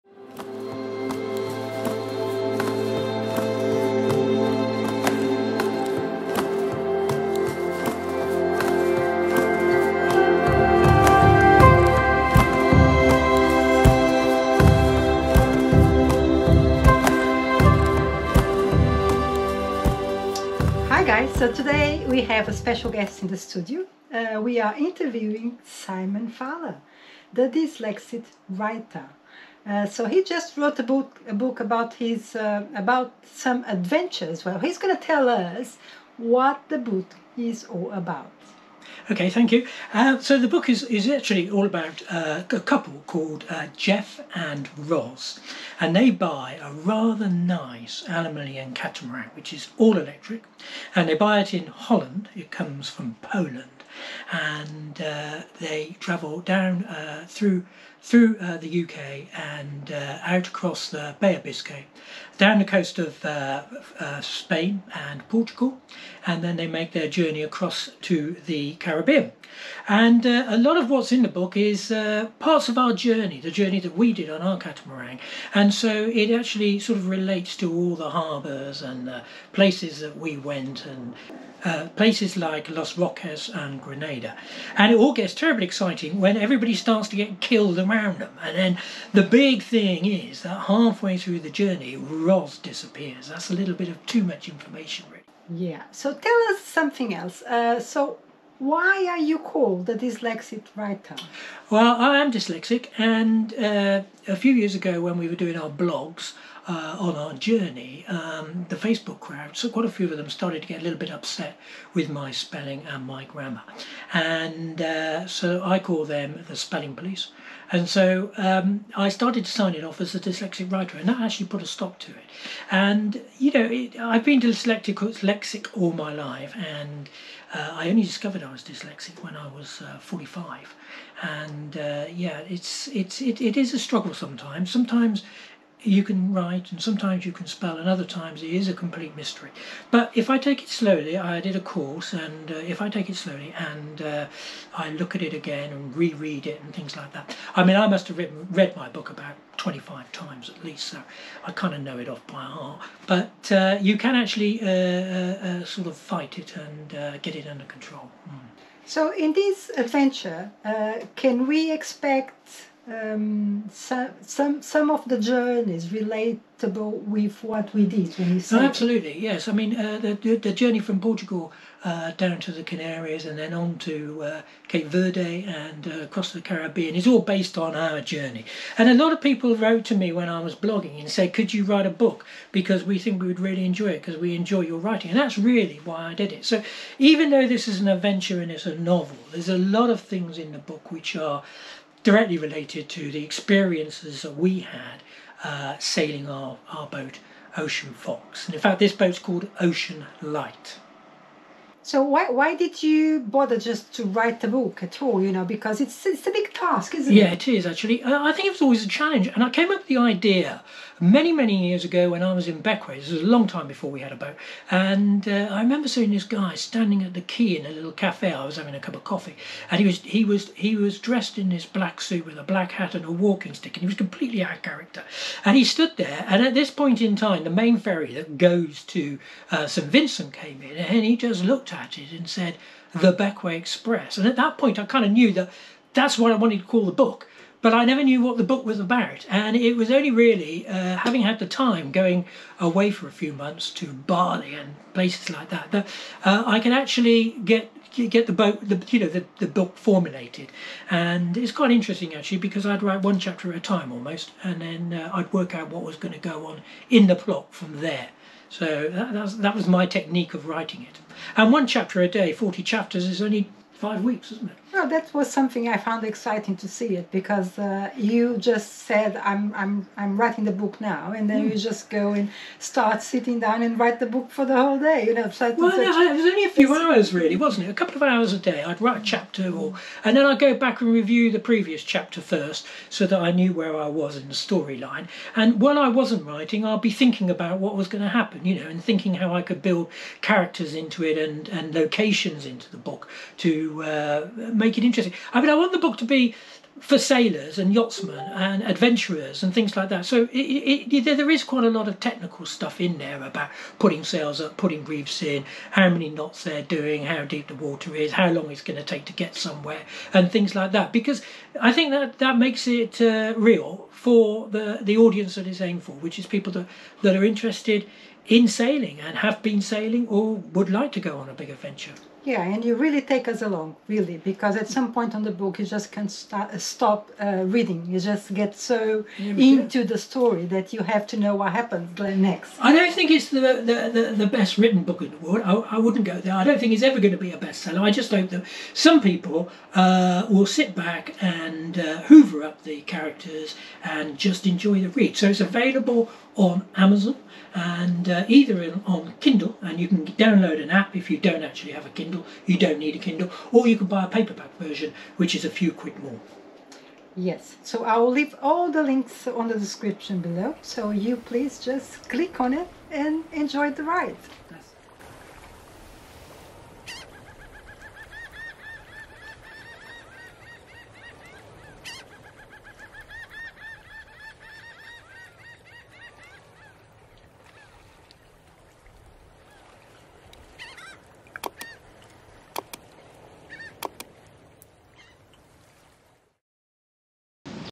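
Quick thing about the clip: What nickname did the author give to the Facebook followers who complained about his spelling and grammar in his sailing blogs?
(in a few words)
the spelling police.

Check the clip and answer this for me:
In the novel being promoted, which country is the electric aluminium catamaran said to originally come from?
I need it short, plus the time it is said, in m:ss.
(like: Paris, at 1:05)
Poland, at 0:53.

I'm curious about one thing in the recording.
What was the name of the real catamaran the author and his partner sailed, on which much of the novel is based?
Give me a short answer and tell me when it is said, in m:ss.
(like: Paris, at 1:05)
Ocean Fox, at 3:17.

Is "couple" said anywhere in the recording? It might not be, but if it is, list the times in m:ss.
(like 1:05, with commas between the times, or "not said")
0:42, 4:37.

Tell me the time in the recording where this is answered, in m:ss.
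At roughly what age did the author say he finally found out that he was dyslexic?
2:09.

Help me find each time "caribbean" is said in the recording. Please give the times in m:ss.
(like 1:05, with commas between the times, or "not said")
1:08, 2:56.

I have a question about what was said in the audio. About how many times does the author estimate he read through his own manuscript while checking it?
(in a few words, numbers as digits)
25.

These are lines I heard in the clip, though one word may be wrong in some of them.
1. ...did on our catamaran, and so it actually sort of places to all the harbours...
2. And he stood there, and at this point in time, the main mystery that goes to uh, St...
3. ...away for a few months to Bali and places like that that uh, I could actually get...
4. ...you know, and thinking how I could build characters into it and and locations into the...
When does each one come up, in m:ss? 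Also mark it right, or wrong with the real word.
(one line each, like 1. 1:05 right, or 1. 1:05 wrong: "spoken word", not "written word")
1. 1:14 wrong: "relates", not "places"
2. 3:45 wrong: "ferry", not "mystery"
3. 4:02 right
4. 4:48 right.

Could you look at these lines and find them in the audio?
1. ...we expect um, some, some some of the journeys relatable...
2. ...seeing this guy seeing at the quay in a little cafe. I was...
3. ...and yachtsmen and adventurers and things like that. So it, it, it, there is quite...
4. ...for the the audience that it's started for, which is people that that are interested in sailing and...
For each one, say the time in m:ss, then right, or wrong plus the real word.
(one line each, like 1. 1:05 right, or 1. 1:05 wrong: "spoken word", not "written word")
1. 2:41 right
2. 3:35 wrong: "standing", not "seeing"
3. 4:57 right
4. 5:14 wrong: "aimed", not "started".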